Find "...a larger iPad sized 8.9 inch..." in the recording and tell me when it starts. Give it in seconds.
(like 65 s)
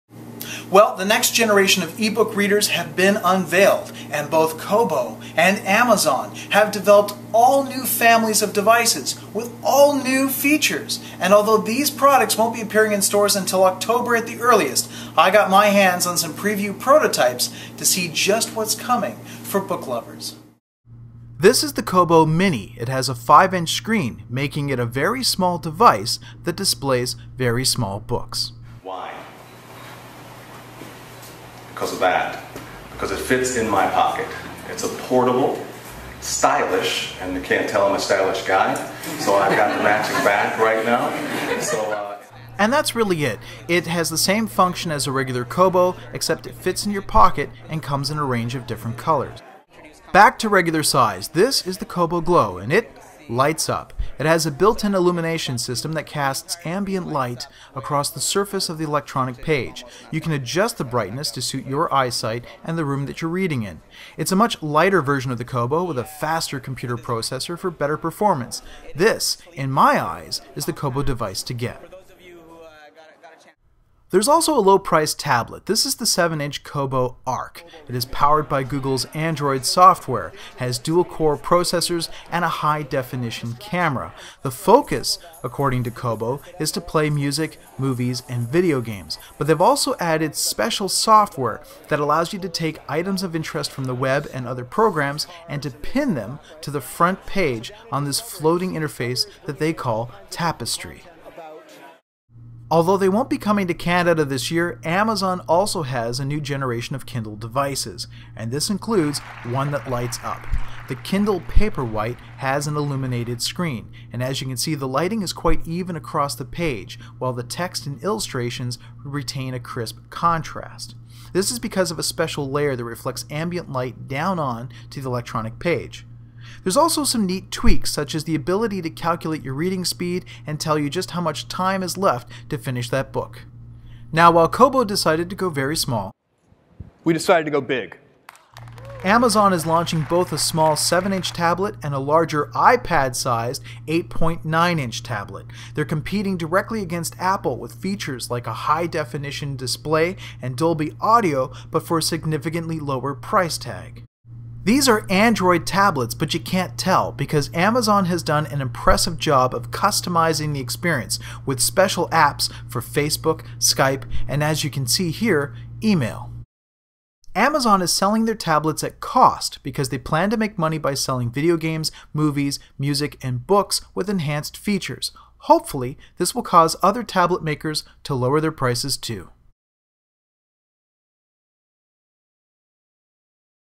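141 s.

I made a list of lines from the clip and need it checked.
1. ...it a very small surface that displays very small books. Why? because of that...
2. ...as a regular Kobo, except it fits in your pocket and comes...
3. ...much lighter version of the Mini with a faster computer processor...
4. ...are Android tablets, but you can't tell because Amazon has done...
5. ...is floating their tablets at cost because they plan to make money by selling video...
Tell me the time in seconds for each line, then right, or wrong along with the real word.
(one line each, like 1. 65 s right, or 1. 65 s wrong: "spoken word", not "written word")
1. 24 s wrong: "device", not "surface"
2. 44 s right
3. 64 s wrong: "Kobo", not "Mini"
4. 154 s right
5. 167 s wrong: "selling", not "floating".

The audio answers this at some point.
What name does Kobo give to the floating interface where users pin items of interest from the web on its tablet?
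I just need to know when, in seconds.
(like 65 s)
100 s.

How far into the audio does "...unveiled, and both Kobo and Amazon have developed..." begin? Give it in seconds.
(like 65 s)
3 s.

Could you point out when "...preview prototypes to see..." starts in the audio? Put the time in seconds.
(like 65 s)
16 s.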